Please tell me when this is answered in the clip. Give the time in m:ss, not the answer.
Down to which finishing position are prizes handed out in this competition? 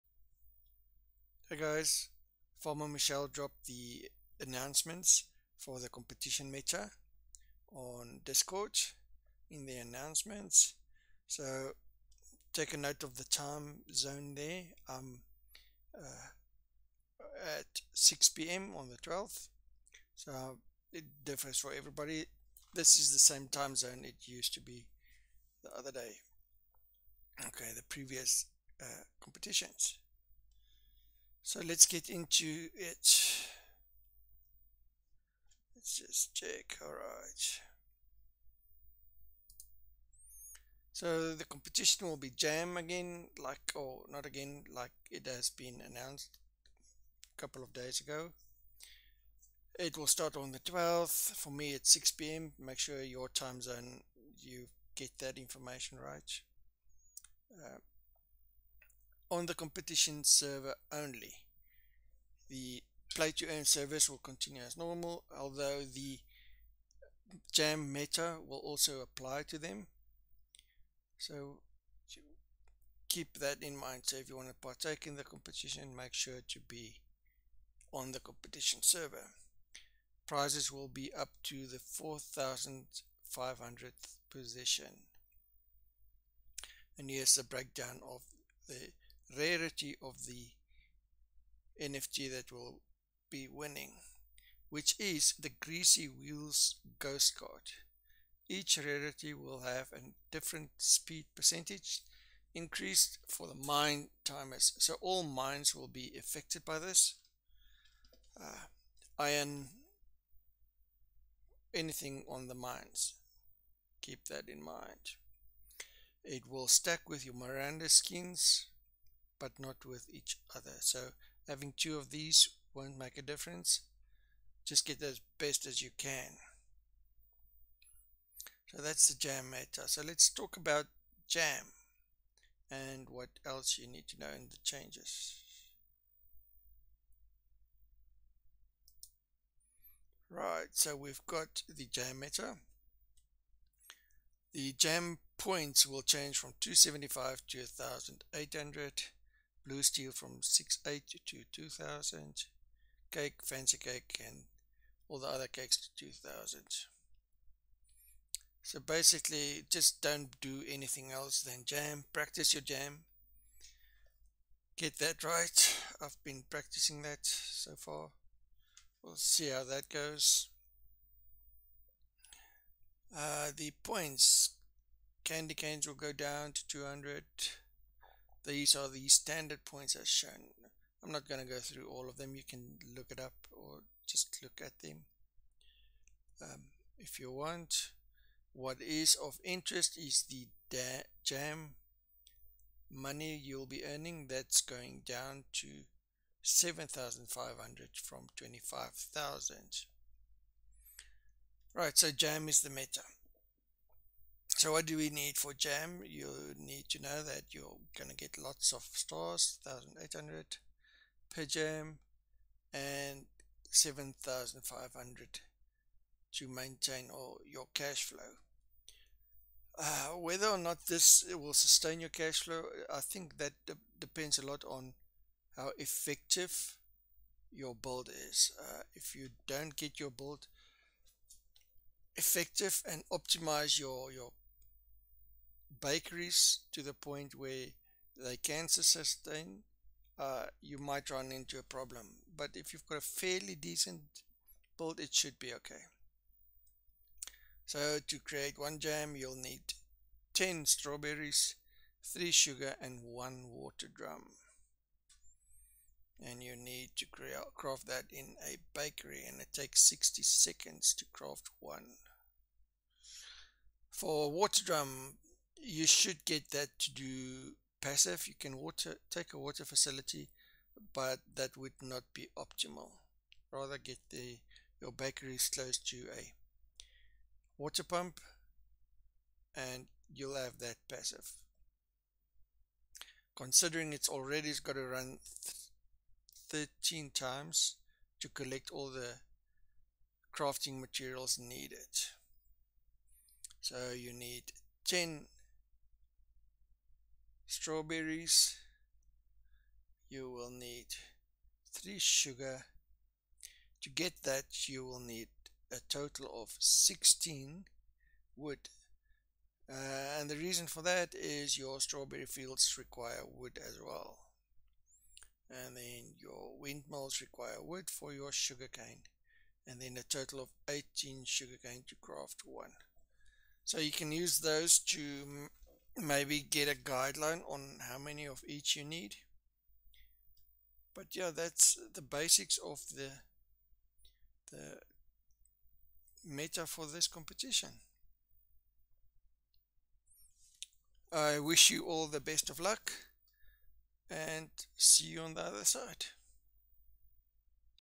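1:21.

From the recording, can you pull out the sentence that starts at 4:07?
So to create one jam, you'll need 10 strawberries, 3 sugar and 1 water drum.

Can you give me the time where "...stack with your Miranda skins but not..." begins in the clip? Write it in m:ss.
1:56.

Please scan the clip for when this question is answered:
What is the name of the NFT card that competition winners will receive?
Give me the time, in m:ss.
1:35.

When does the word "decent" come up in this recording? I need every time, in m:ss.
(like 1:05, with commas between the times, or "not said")
4:03.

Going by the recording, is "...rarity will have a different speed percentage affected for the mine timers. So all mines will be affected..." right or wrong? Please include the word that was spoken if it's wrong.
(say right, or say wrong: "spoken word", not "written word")
wrong: "increased", not "affected".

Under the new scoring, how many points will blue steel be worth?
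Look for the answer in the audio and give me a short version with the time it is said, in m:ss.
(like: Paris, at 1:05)
2000, at 2:29.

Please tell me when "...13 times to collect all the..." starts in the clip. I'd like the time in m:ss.
4:46.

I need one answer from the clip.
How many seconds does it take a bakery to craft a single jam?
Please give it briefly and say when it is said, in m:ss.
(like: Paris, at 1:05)
60, at 4:19.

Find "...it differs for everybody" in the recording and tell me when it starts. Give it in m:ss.
0:20.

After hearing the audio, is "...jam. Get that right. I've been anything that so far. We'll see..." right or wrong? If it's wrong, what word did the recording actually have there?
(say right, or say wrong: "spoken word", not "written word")
wrong: "practicing", not "anything".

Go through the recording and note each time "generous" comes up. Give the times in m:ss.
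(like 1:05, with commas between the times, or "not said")
not said.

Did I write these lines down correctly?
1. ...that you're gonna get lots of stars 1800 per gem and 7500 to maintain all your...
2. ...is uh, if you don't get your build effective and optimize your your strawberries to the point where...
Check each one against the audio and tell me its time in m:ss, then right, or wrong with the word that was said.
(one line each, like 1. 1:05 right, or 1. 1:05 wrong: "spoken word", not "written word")
1. 3:27 right
2. 3:48 wrong: "bakeries", not "strawberries".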